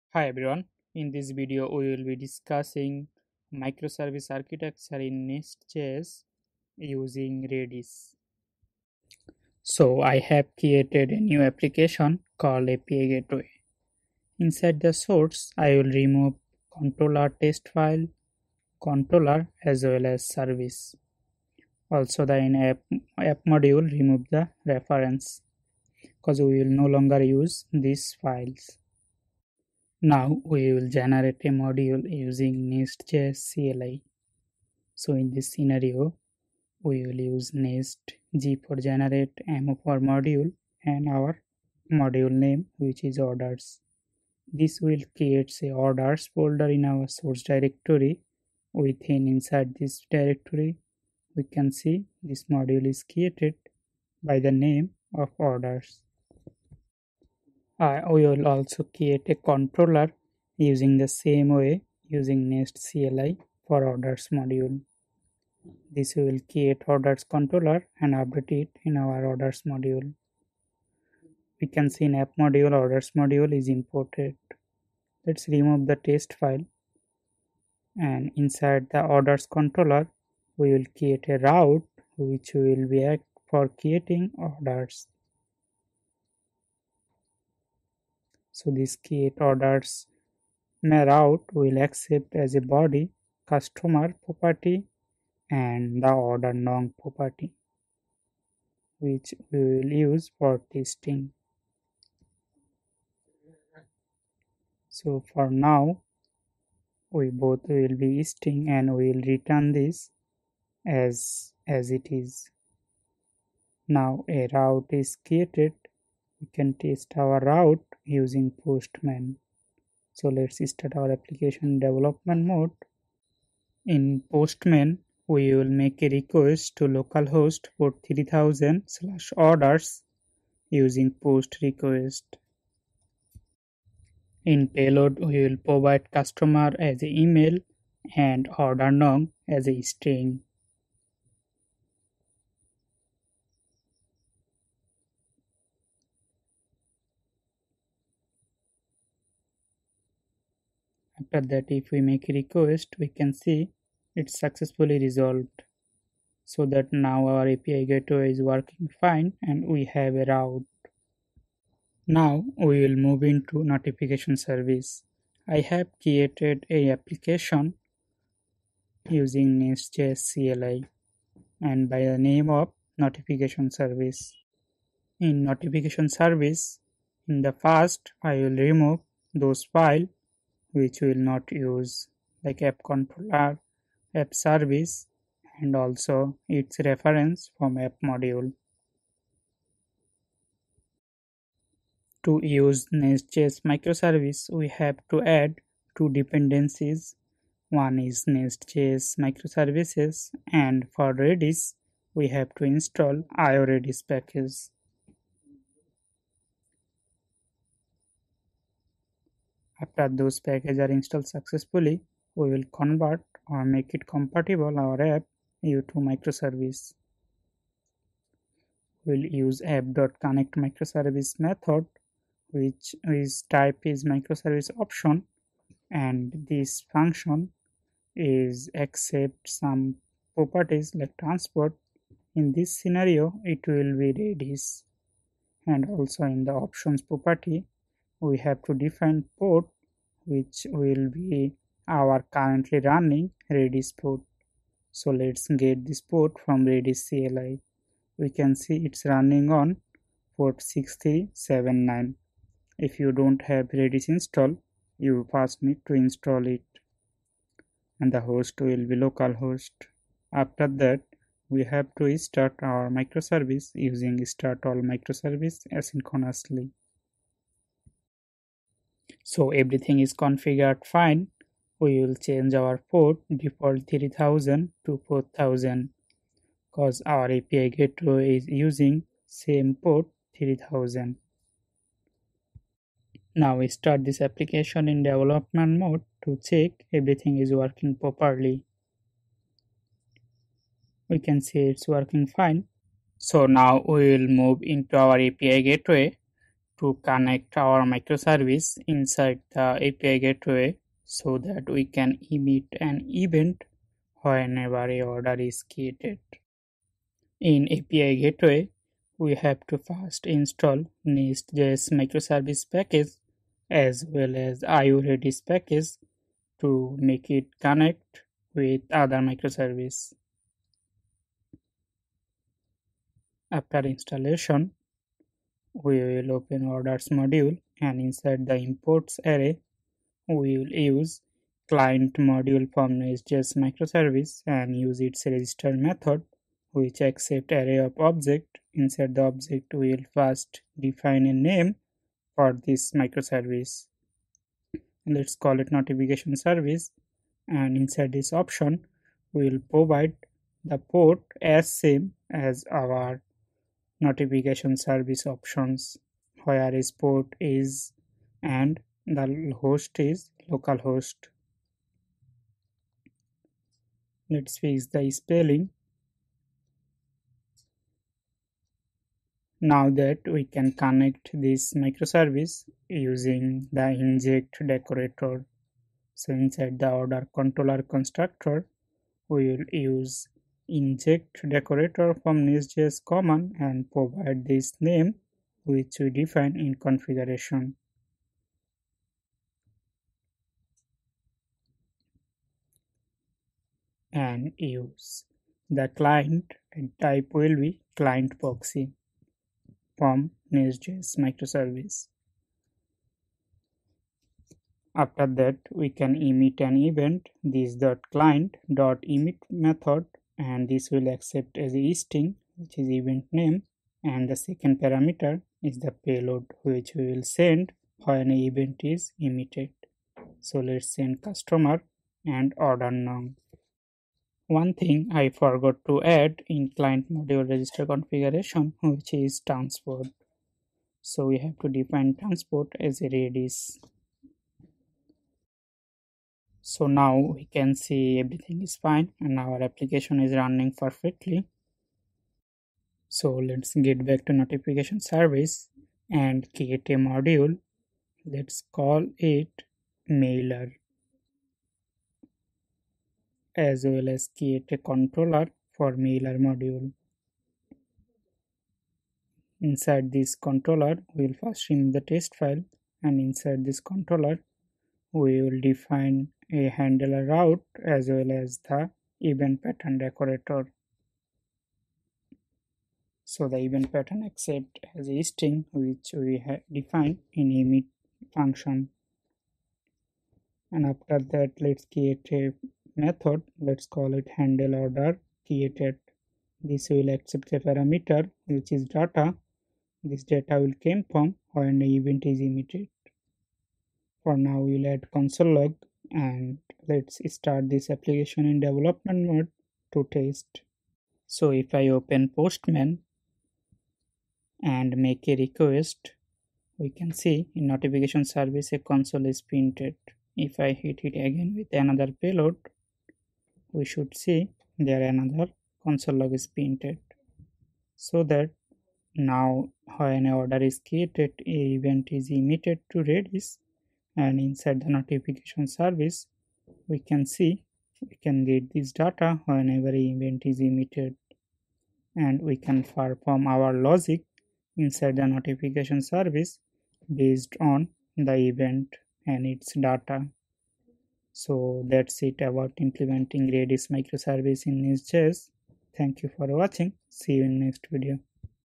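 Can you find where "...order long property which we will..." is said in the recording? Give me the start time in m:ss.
1:36.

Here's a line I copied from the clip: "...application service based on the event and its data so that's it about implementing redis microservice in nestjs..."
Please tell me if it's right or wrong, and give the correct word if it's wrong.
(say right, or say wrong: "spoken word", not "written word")
wrong: "notification", not "application".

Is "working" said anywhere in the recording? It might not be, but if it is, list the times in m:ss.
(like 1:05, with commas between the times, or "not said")
2:38, 4:47, 4:51.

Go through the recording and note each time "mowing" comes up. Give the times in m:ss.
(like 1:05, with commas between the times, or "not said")
not said.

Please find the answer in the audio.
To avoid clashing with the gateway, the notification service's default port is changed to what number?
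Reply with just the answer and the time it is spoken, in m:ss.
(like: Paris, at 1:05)
4000, at 4:35.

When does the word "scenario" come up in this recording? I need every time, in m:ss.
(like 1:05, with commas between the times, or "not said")
0:35, 3:52.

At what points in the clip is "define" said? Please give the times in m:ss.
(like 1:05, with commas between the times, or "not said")
3:58, 5:40, 6:26, 7:11, 7:45, 7:56.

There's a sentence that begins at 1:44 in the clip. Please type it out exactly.
So for now we both will be testing and we will return this as as it is.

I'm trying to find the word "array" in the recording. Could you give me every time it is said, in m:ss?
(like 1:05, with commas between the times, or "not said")
5:29, 5:37.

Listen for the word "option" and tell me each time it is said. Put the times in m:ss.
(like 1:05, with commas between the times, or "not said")
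3:44, 3:56, 5:48, 5:55.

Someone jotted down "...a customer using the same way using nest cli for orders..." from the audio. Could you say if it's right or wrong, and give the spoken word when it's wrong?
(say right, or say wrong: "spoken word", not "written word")
wrong: "controller", not "customer".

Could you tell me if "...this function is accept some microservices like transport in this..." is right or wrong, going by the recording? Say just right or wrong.
wrong.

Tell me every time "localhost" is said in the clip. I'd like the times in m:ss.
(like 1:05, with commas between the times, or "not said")
2:06, 4:19, 6:00.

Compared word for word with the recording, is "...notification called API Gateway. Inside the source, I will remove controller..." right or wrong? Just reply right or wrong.
wrong.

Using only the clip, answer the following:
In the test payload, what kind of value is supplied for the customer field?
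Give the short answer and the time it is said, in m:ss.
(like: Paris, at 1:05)
an email, at 2:16.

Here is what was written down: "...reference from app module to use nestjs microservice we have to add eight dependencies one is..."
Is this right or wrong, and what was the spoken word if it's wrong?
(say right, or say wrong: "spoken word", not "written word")
wrong: "two", not "eight".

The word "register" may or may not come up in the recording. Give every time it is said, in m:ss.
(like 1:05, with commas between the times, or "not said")
5:35, 7:07.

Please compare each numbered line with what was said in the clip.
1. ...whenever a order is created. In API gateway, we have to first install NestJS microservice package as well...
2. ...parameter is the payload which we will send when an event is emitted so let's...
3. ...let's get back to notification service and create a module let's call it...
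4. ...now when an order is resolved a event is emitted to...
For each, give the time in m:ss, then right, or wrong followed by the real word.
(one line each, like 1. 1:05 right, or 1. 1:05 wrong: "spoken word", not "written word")
1. 5:04 right
2. 6:54 right
3. 7:23 right
4. 8:39 wrong: "created", not "resolved".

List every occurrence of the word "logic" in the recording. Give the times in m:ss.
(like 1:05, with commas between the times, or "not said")
8:53.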